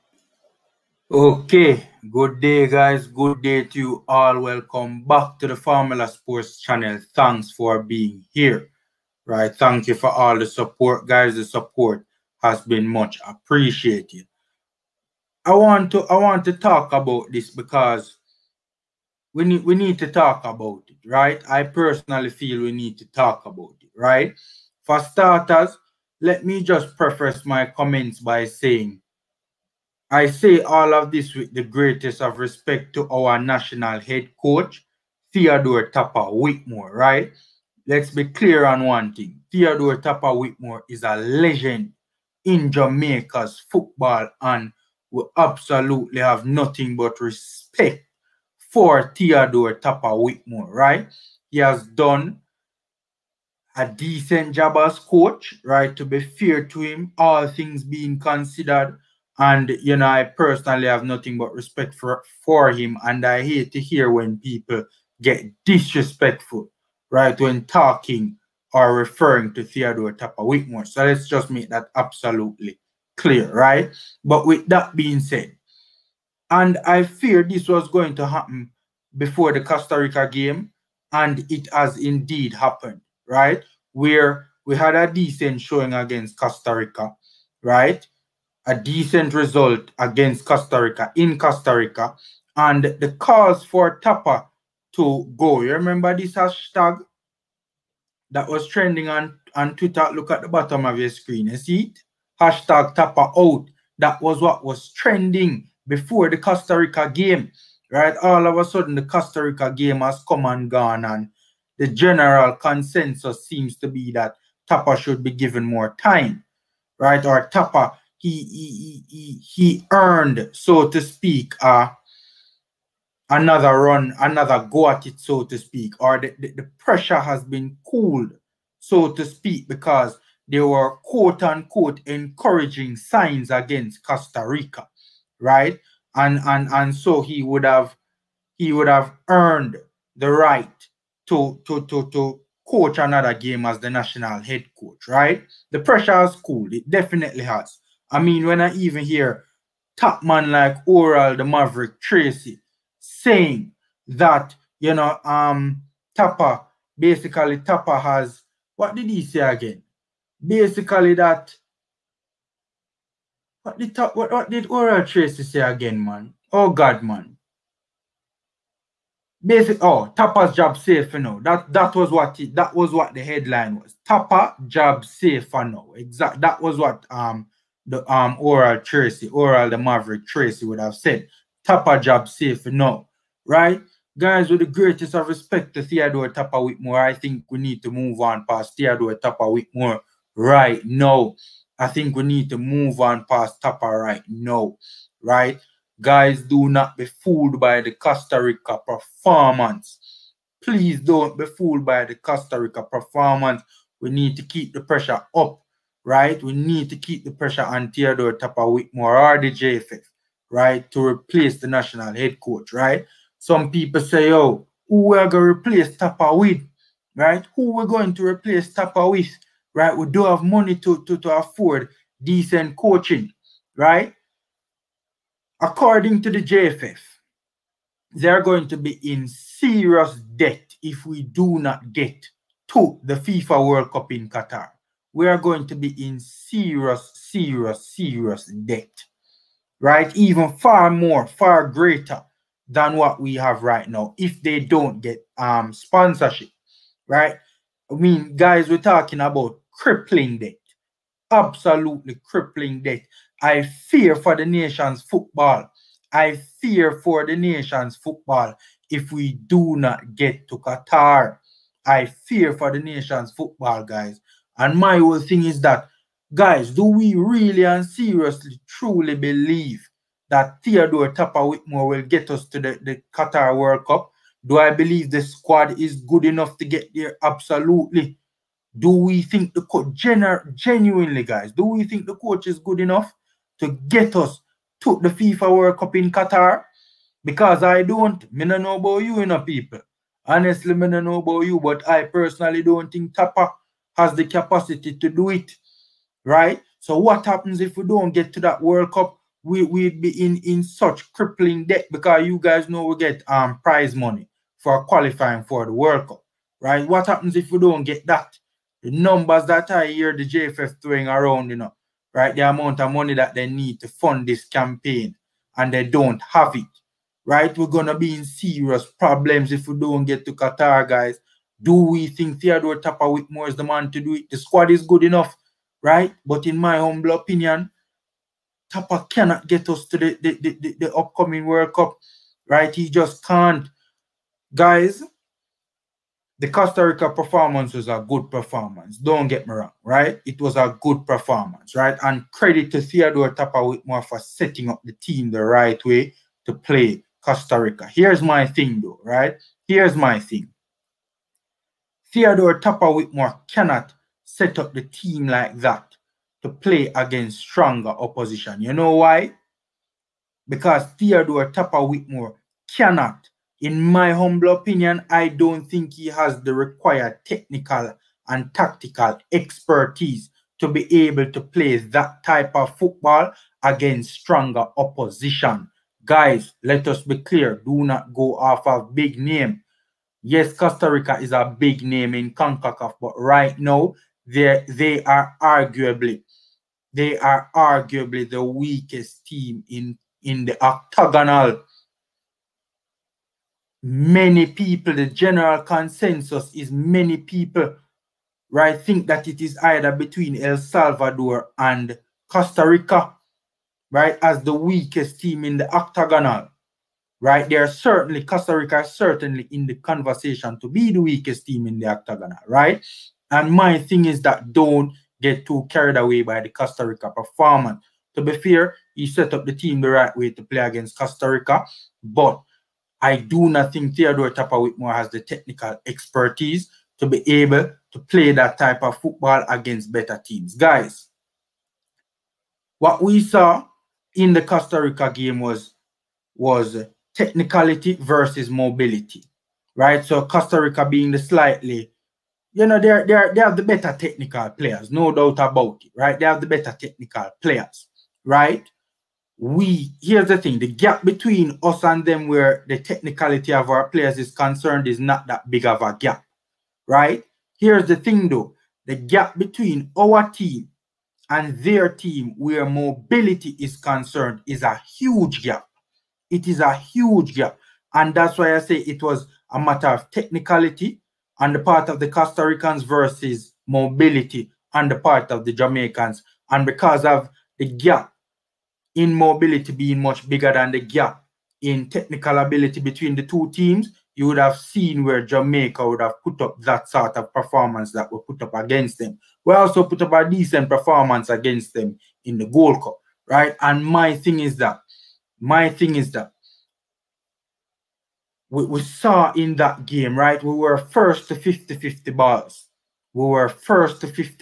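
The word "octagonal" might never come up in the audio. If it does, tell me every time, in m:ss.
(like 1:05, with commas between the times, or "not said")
6:30, 6:45, 6:51.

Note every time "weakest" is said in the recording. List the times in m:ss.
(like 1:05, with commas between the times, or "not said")
6:28, 6:44, 6:50.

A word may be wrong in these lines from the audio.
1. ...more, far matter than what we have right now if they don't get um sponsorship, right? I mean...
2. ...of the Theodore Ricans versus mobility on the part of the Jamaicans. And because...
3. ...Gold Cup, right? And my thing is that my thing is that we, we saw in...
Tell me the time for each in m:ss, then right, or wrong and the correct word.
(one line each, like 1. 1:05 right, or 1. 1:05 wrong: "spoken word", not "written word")
1. 4:00 wrong: "greater", not "matter"
2. 7:51 wrong: "Costa", not "Theodore"
3. 8:12 right.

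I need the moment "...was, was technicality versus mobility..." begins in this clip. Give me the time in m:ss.
7:15.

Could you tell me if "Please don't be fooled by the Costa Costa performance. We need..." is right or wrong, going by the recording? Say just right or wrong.
wrong.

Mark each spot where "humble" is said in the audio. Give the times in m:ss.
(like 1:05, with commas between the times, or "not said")
5:26, 6:04.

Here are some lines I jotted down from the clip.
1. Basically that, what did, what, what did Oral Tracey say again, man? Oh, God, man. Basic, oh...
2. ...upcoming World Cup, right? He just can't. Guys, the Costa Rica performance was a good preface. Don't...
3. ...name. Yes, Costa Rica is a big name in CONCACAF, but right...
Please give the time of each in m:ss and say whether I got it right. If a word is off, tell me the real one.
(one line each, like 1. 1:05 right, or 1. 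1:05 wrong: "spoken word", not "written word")
1. 2:40 right
2. 5:30 wrong: "performance", not "preface"
3. 6:19 right.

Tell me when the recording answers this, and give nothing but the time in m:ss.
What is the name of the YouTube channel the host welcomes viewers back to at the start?
0:05.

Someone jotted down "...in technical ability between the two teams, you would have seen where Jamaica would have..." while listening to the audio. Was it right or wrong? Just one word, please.
right.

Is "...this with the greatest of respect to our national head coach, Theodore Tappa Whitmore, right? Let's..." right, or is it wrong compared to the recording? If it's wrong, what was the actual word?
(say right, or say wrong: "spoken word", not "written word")
right.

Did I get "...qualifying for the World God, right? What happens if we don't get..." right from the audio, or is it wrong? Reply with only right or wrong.
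wrong.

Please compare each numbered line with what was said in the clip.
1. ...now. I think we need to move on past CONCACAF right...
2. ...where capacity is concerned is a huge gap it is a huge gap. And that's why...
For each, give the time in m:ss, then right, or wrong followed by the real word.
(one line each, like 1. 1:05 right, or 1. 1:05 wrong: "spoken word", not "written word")
1. 3:10 wrong: "Tappa", not "CONCACAF"
2. 7:42 wrong: "mobility", not "capacity".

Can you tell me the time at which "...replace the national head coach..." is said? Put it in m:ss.
3:31.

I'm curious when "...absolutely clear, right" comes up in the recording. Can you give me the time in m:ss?
1:11.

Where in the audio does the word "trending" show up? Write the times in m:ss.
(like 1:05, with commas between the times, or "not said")
1:38, 1:44.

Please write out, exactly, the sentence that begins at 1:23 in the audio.
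Where we had a decent showing against Costa Rica, right?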